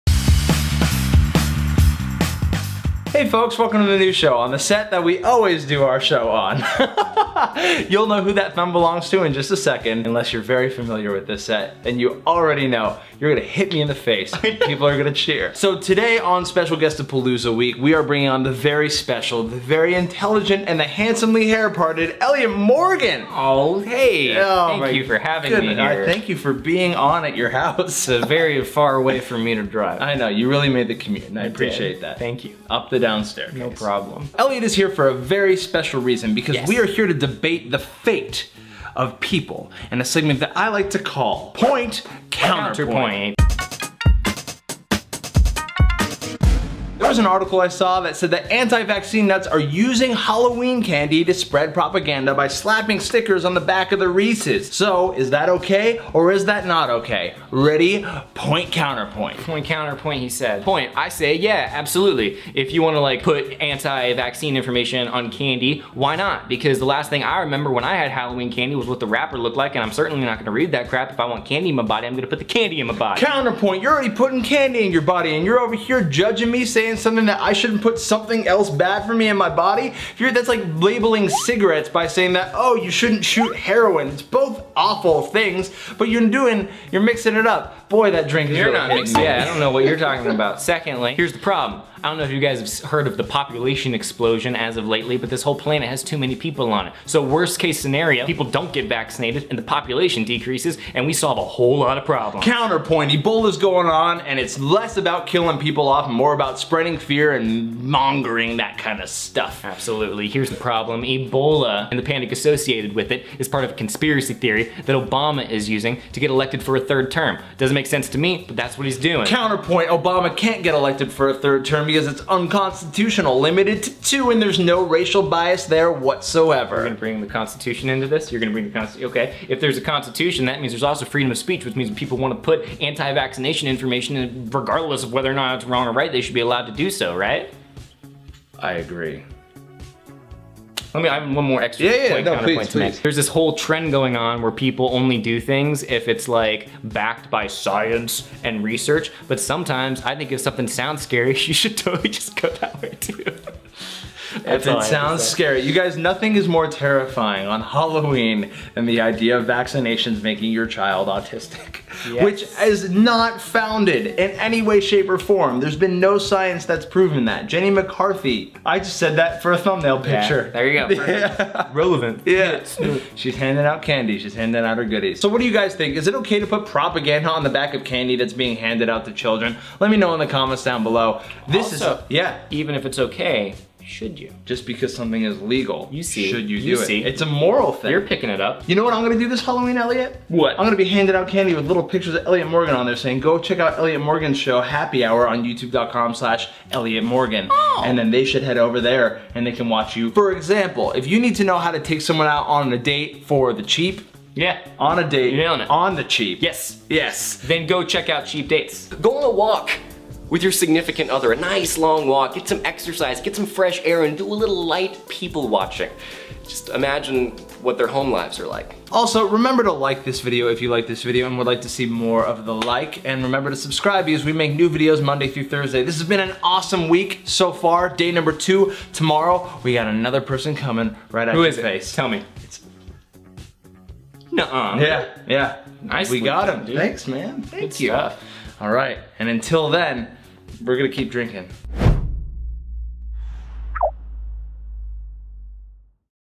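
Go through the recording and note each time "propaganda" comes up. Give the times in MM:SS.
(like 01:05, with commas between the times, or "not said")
00:51, 02:56.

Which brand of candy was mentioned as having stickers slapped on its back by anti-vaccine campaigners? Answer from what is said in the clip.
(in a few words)
Reese's.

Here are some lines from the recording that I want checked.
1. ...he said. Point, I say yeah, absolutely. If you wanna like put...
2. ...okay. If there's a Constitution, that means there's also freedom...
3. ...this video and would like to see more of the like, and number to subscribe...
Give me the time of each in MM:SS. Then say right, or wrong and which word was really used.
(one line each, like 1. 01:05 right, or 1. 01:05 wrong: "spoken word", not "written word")
1. 01:00 right
2. 02:09 right
3. 03:40 wrong: "remember", not "number".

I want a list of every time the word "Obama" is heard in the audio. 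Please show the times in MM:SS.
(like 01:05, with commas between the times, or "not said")
01:54, 01:59.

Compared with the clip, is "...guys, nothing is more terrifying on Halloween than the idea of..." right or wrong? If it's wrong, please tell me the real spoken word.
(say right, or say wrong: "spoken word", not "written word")
right.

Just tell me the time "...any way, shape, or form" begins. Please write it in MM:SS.
02:44.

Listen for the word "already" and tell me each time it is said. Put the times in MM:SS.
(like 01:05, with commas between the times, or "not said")
00:12, 01:13.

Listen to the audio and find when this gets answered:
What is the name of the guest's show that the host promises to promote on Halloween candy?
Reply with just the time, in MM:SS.
03:14.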